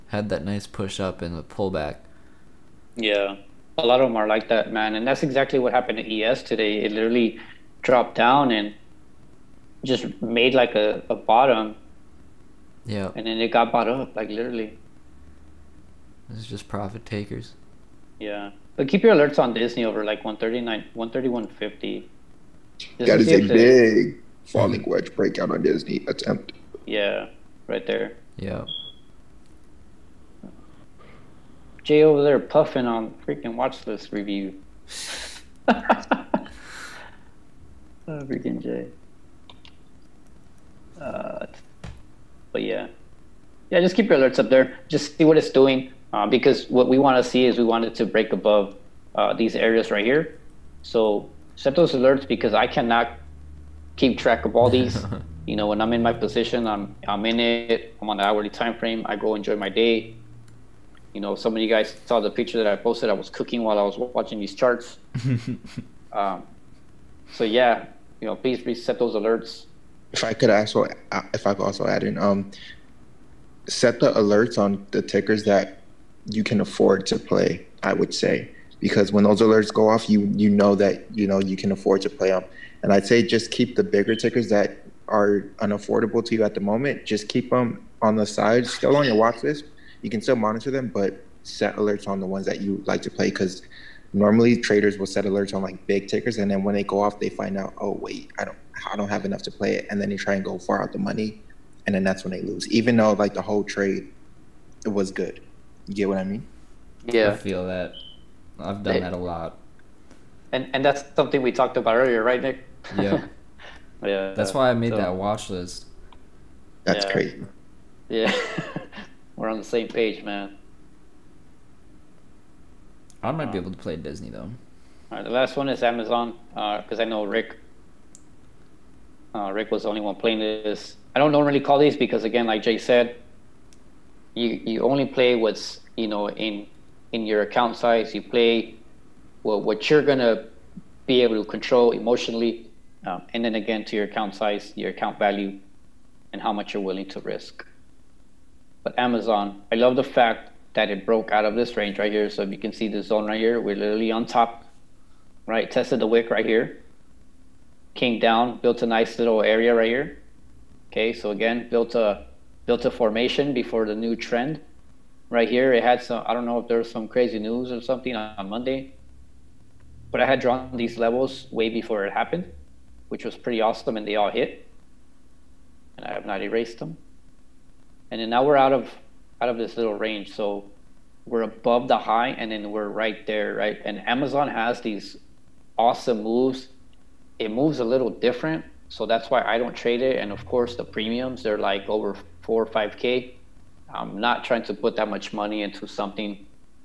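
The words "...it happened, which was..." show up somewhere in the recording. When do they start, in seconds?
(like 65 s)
172 s.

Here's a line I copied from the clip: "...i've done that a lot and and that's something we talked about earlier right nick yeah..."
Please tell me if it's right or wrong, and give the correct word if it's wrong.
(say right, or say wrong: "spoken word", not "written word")
right.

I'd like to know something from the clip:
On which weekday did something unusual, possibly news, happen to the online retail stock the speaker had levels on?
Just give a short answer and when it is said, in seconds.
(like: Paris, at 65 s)
Monday, at 168 s.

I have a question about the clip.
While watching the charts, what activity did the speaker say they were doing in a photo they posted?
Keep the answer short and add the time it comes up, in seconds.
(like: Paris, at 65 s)
Cooking, at 63 s.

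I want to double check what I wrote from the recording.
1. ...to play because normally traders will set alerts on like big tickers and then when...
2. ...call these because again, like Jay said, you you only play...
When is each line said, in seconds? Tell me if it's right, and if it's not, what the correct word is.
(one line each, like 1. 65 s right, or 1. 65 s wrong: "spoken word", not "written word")
1. 93 s right
2. 131 s right.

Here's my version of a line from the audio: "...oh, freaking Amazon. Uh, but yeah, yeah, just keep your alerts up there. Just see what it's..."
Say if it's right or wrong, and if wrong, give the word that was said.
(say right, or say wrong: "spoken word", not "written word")
wrong: "Jay", not "Amazon".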